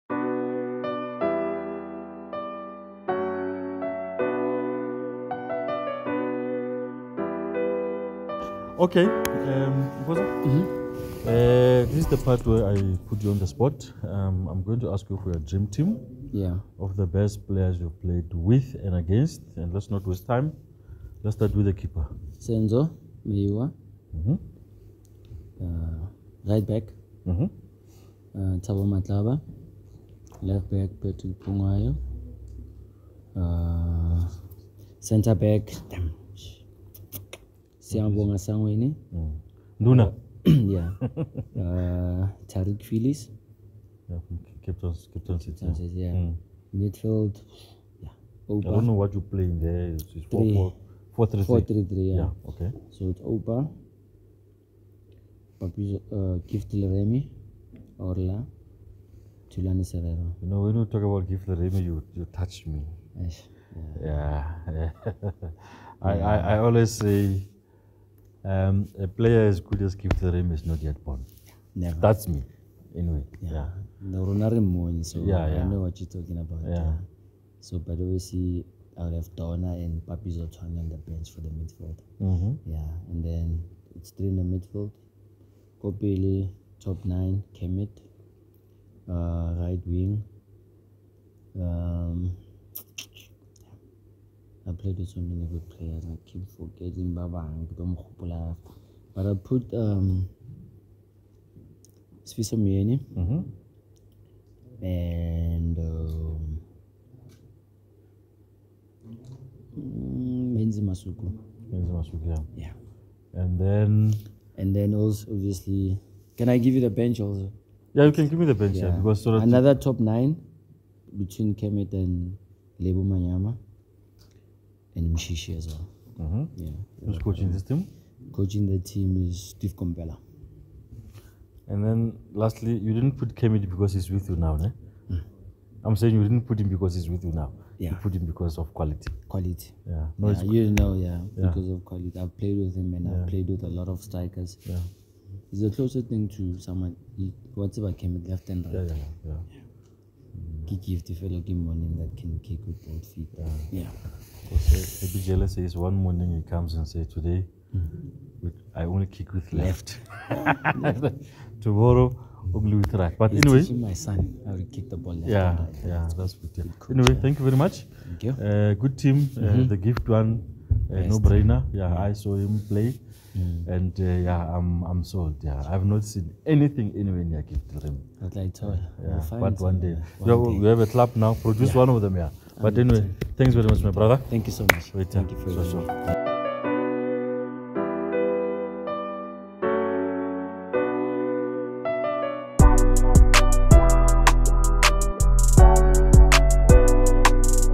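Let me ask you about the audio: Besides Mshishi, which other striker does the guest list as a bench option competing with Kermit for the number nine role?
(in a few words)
Lebo Manyama.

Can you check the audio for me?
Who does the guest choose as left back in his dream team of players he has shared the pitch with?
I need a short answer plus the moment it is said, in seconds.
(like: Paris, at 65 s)
Patrick Phungwayo, at 31 s.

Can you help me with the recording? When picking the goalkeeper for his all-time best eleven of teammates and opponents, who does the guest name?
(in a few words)
Senzo Meyiwa.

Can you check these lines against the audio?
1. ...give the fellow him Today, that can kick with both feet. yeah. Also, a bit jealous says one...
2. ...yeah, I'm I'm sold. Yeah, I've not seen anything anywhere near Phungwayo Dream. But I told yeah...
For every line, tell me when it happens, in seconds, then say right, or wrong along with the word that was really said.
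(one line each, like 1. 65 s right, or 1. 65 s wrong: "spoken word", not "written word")
1. 150 s wrong: "Morning", not "Today"
2. 174 s wrong: "Cape", not "Phungwayo".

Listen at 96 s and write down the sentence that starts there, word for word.
I keep forgetting Baba and Domkhupula.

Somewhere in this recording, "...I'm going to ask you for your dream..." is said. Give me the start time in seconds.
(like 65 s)
14 s.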